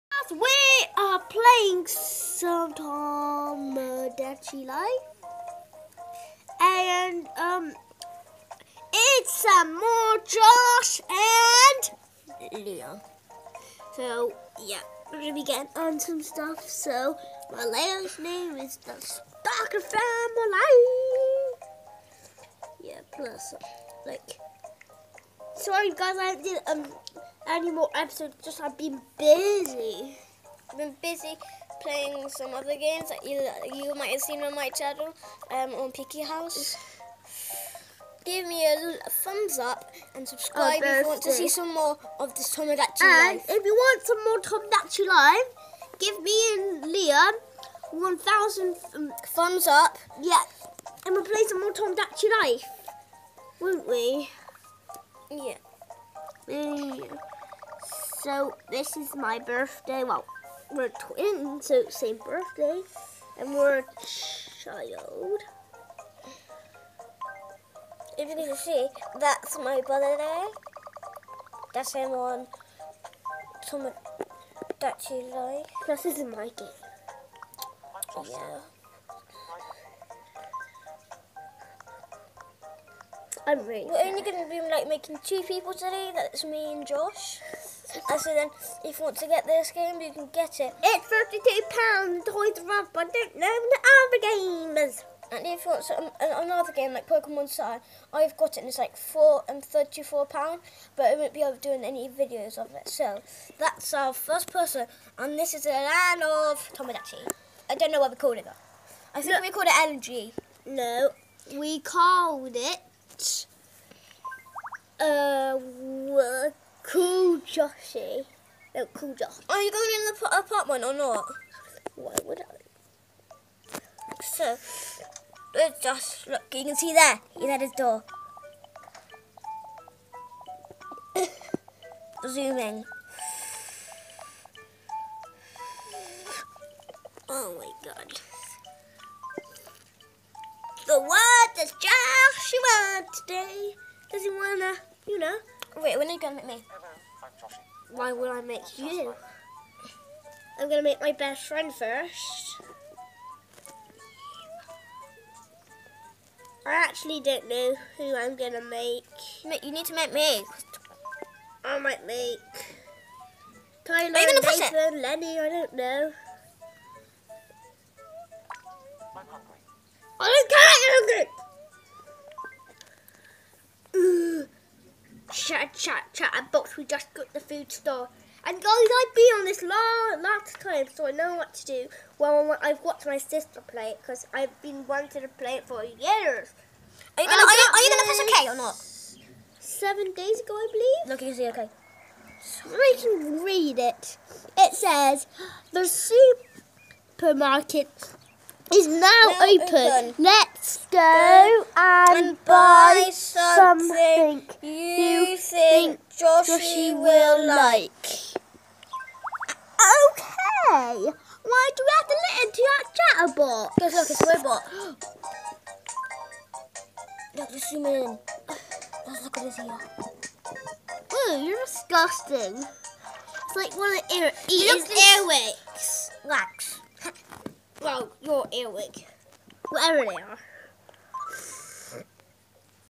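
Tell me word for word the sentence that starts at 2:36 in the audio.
I actually don't know who I'm going to make.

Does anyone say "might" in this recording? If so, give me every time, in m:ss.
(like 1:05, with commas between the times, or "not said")
0:33, 2:41.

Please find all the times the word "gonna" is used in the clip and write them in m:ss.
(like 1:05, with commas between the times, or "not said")
0:15, 3:07.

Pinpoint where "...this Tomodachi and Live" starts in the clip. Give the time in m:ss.
0:42.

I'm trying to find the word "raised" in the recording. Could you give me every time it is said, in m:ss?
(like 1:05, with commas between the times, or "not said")
not said.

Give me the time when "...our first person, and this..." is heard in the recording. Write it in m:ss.
1:43.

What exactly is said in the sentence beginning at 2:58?
And guys, I've been on this last last time, so I know what to do.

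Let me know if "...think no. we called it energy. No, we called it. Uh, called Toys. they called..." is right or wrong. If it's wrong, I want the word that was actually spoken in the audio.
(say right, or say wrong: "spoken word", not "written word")
wrong: "Joshy", not "Toys".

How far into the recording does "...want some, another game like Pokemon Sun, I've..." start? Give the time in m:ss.
1:35.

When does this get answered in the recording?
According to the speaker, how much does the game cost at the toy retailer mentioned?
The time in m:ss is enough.
1:31.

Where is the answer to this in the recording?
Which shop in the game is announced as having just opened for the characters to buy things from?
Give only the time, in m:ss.
3:17.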